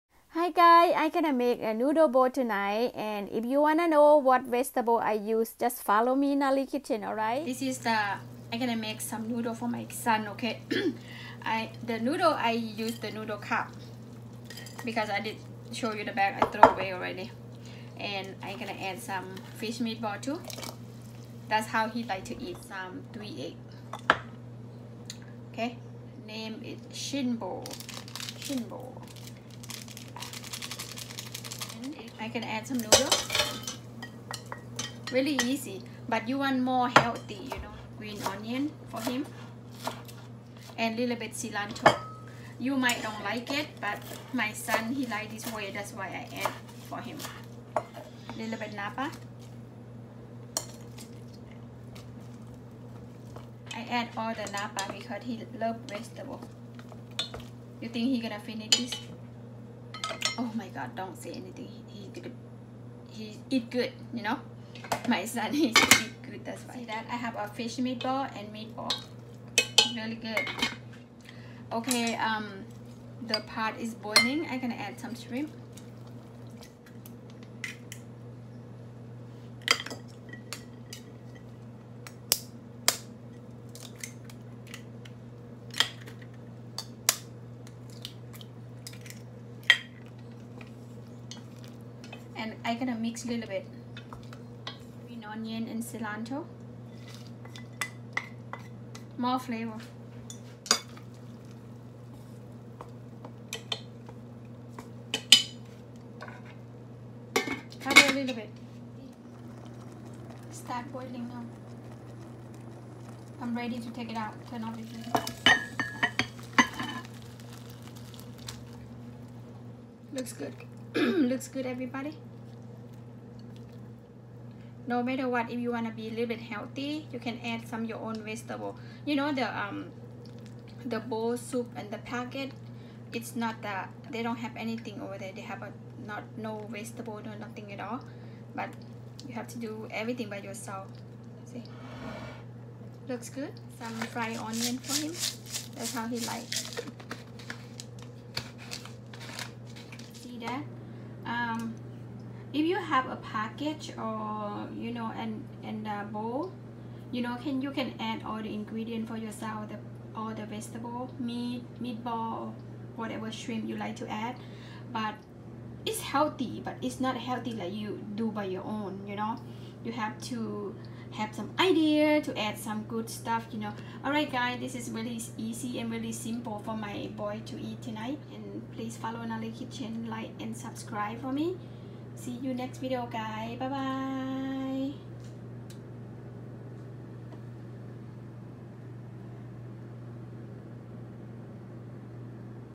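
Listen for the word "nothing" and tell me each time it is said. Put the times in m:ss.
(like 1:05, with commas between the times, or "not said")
2:17.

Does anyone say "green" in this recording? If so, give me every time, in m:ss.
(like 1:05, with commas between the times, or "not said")
0:37, 1:35.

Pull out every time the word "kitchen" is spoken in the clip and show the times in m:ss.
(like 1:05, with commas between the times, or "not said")
0:06, 2:59.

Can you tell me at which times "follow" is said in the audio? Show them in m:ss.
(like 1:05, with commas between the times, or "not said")
0:05, 2:58.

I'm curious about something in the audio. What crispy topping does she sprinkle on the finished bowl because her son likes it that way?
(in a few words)
fried onion.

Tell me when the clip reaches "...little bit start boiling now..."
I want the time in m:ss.
1:48.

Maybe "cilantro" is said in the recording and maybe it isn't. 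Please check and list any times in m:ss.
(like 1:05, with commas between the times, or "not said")
0:41, 1:35.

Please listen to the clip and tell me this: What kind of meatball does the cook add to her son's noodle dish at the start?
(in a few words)
fish meat ball.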